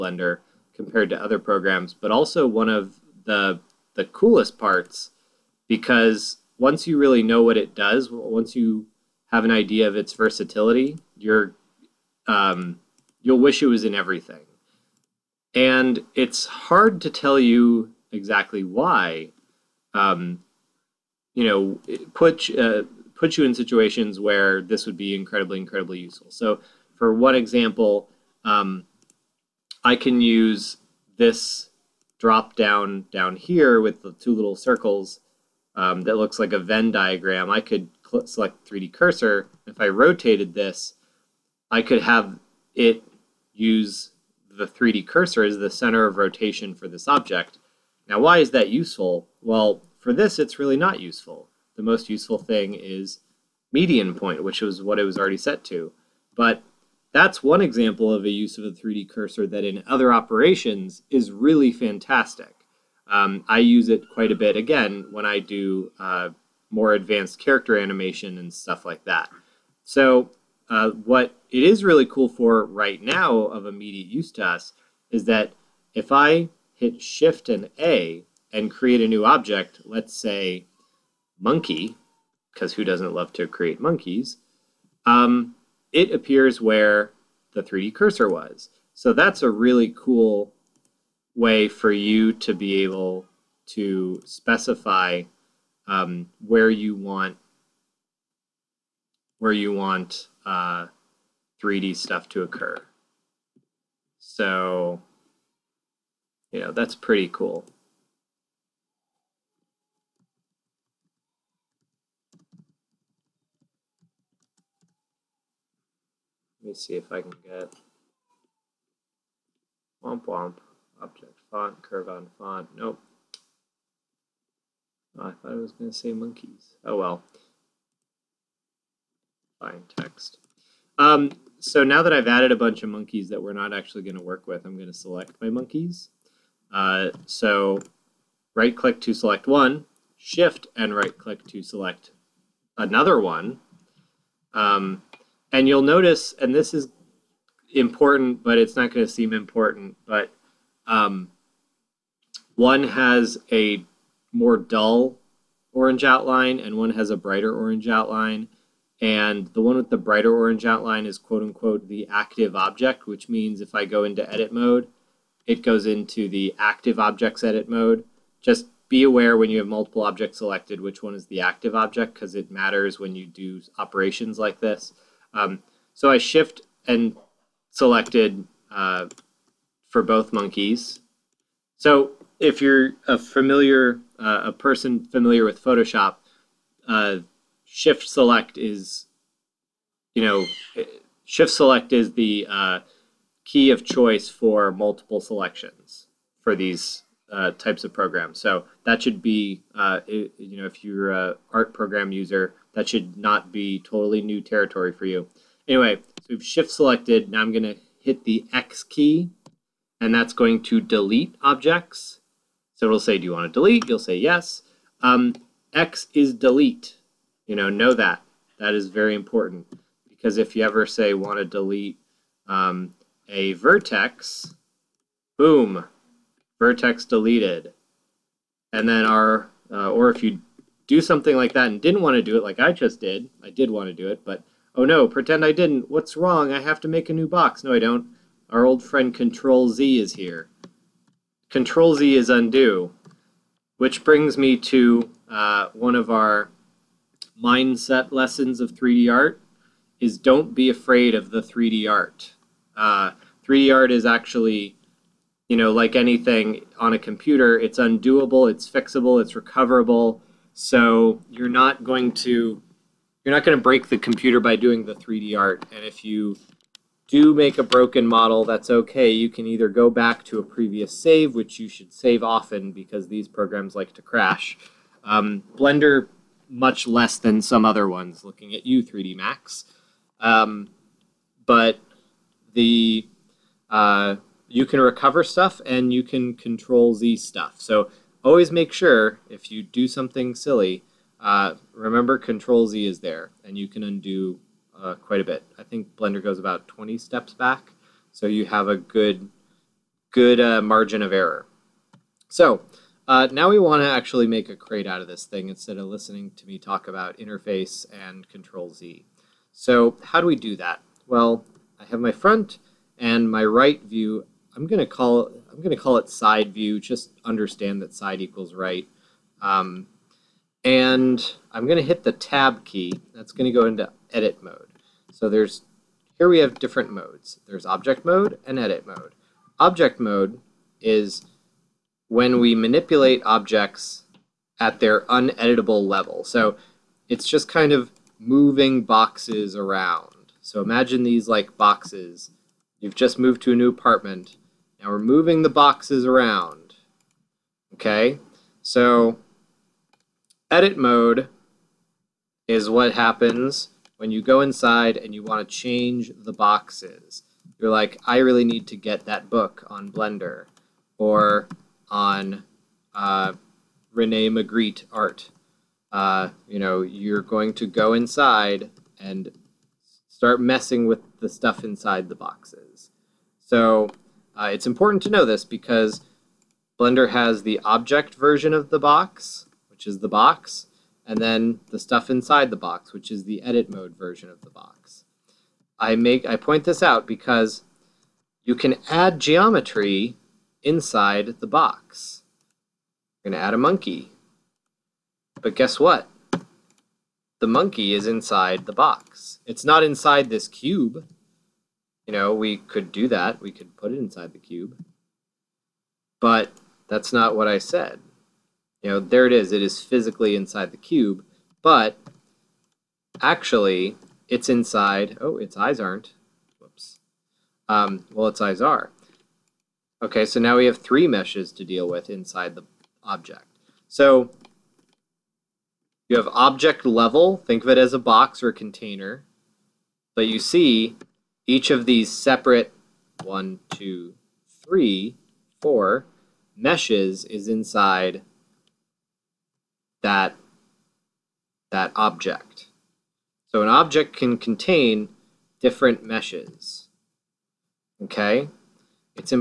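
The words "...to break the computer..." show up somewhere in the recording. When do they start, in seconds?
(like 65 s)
263 s.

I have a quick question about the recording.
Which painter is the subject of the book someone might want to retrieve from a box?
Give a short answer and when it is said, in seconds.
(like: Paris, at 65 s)
Rene Magritte, at 363 s.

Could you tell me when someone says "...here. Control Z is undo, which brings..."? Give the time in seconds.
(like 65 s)
240 s.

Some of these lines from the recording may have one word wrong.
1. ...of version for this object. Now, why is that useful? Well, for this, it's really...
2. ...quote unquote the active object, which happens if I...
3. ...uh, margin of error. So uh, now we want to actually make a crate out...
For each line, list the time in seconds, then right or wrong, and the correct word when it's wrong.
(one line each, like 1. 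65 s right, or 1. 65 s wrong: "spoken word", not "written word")
1. 46 s wrong: "rotation", not "version"
2. 161 s wrong: "means", not "happens"
3. 300 s right.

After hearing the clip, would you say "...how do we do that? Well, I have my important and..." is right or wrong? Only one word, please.
wrong.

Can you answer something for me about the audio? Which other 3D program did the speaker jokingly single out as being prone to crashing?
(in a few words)
3D Max.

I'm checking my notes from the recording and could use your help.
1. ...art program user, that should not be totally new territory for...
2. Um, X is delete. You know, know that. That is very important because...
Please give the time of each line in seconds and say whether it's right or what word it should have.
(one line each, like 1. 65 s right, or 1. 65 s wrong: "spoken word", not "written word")
1. 201 s right
2. 215 s right.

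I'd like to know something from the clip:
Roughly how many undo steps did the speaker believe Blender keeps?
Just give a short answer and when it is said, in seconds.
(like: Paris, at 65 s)
20, at 296 s.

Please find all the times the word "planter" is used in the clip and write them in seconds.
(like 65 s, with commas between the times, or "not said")
not said.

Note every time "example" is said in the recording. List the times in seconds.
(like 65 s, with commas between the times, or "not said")
27 s, 57 s.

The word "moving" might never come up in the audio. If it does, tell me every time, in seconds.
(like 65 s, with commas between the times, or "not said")
338 s, 344 s.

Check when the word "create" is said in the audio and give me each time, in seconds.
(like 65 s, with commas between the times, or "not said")
78 s, 83 s.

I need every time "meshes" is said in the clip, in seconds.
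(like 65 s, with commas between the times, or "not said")
421 s, 436 s, 446 s.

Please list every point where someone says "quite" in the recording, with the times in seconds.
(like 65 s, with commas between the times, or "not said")
64 s, 294 s.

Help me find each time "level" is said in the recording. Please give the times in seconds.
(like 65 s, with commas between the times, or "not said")
335 s, 426 s.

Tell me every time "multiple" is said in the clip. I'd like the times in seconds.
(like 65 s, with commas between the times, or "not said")
169 s, 194 s.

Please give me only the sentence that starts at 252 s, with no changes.
Uh, 3D art is actually, you know, like anything on a computer, it's undoable, it's fixable, it's recoverable.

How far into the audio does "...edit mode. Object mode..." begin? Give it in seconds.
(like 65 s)
328 s.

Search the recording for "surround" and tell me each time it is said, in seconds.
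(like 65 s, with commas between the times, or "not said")
not said.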